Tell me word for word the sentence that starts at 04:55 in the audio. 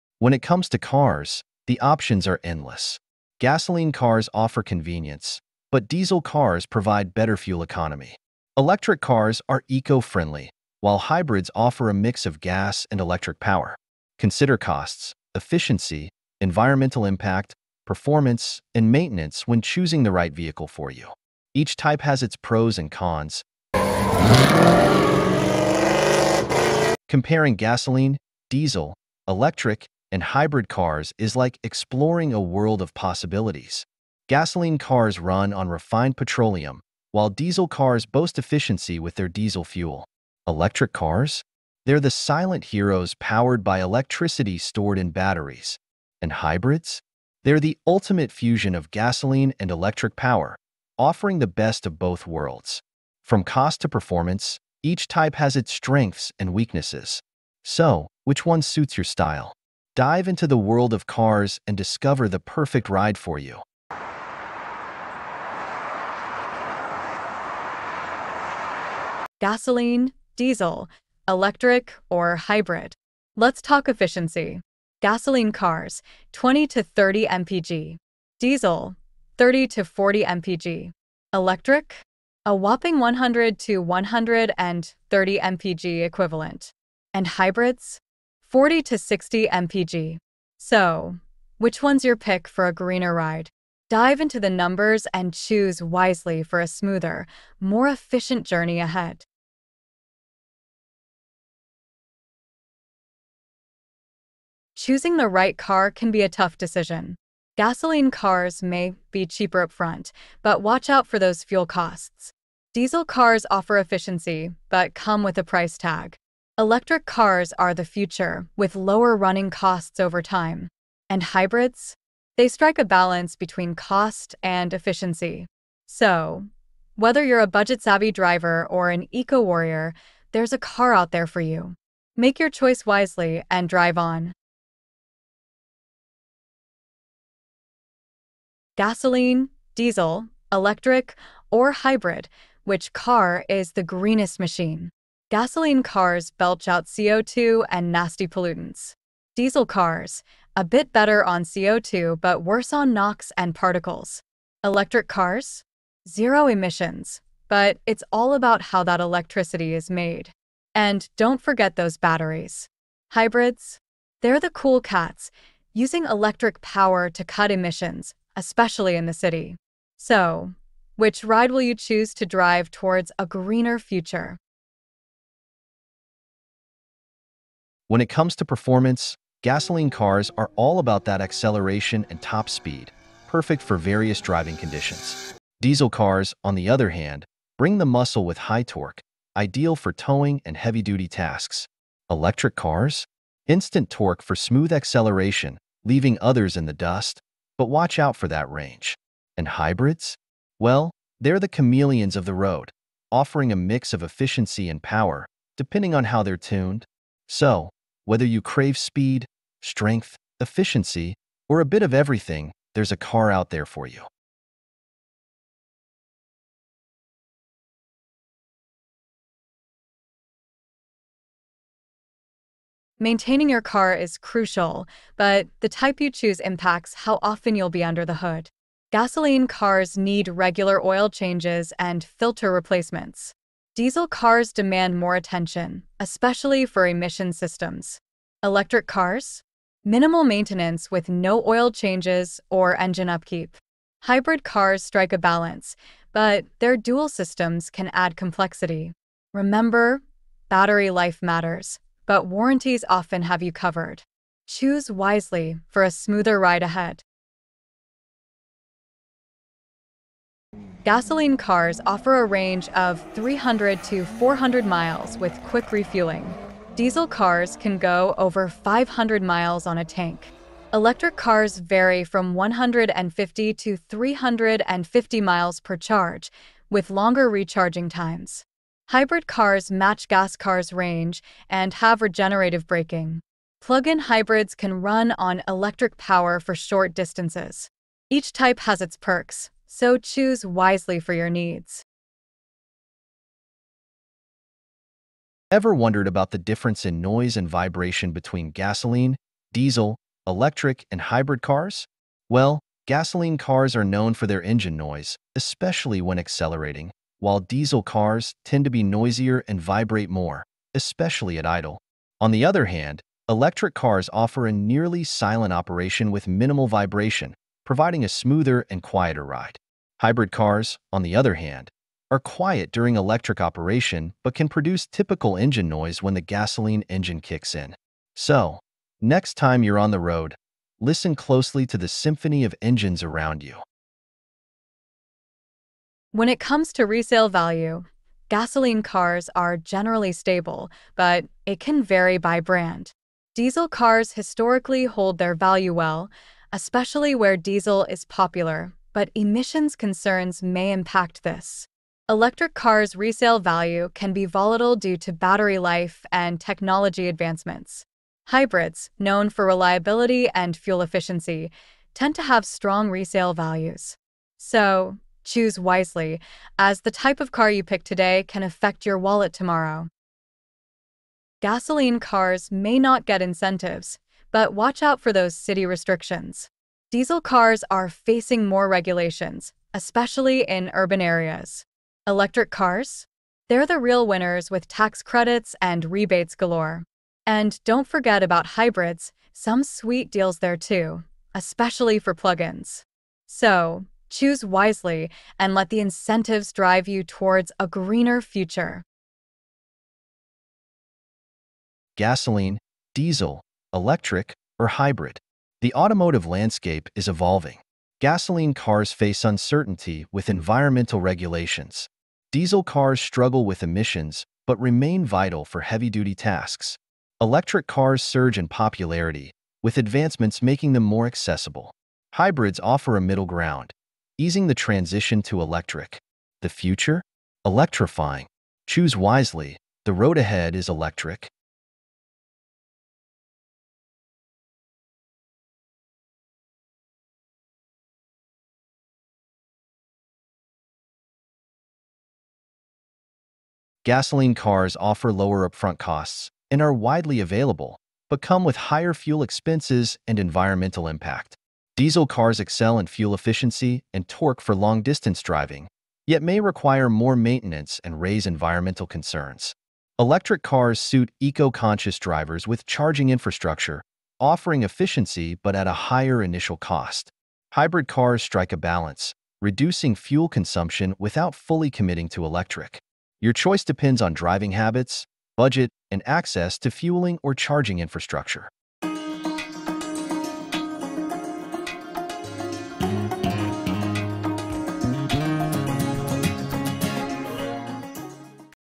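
Ever wondered about the difference in noise and vibration between gasoline, diesel, electric, and hybrid cars?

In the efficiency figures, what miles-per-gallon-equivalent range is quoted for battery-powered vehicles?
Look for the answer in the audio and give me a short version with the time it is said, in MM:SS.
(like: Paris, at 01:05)
100 to 130, at 01:22.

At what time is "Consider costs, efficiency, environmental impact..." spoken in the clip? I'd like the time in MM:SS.
00:14.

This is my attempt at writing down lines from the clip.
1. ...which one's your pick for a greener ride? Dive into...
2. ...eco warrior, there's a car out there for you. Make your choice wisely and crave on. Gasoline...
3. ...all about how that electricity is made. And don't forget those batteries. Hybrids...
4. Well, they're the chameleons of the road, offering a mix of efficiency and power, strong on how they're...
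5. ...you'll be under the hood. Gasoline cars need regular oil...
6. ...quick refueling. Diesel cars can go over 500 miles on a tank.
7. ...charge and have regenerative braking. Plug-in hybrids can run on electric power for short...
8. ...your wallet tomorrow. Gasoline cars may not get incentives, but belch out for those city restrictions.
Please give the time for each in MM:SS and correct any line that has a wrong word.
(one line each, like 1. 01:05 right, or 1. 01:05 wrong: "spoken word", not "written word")
1. 01:31 right
2. 02:09 wrong: "drive", not "crave"
3. 02:38 right
4. 03:20 wrong: "depending", not "strong"
5. 03:47 right
6. 04:25 right
7. 04:40 wrong: "range", not "charge"
8. 06:08 wrong: "watch", not "belch".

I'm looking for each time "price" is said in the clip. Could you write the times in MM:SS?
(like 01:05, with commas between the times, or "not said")
01:55.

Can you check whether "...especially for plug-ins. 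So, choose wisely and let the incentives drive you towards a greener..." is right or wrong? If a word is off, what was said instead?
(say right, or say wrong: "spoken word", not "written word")
right.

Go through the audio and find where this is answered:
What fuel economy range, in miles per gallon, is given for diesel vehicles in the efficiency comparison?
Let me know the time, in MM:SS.
01:19.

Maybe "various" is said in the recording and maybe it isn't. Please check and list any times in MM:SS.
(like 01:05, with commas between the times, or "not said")
03:03.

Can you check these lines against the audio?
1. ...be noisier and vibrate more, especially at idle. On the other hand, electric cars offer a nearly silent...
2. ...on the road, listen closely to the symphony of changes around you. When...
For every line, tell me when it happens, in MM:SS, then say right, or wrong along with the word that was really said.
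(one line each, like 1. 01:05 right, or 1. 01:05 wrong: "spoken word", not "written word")
1. 05:08 right
2. 05:29 wrong: "engines", not "changes".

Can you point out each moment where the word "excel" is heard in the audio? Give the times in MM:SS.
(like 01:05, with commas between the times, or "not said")
07:32.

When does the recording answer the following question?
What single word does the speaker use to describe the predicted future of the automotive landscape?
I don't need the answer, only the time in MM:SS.
07:07.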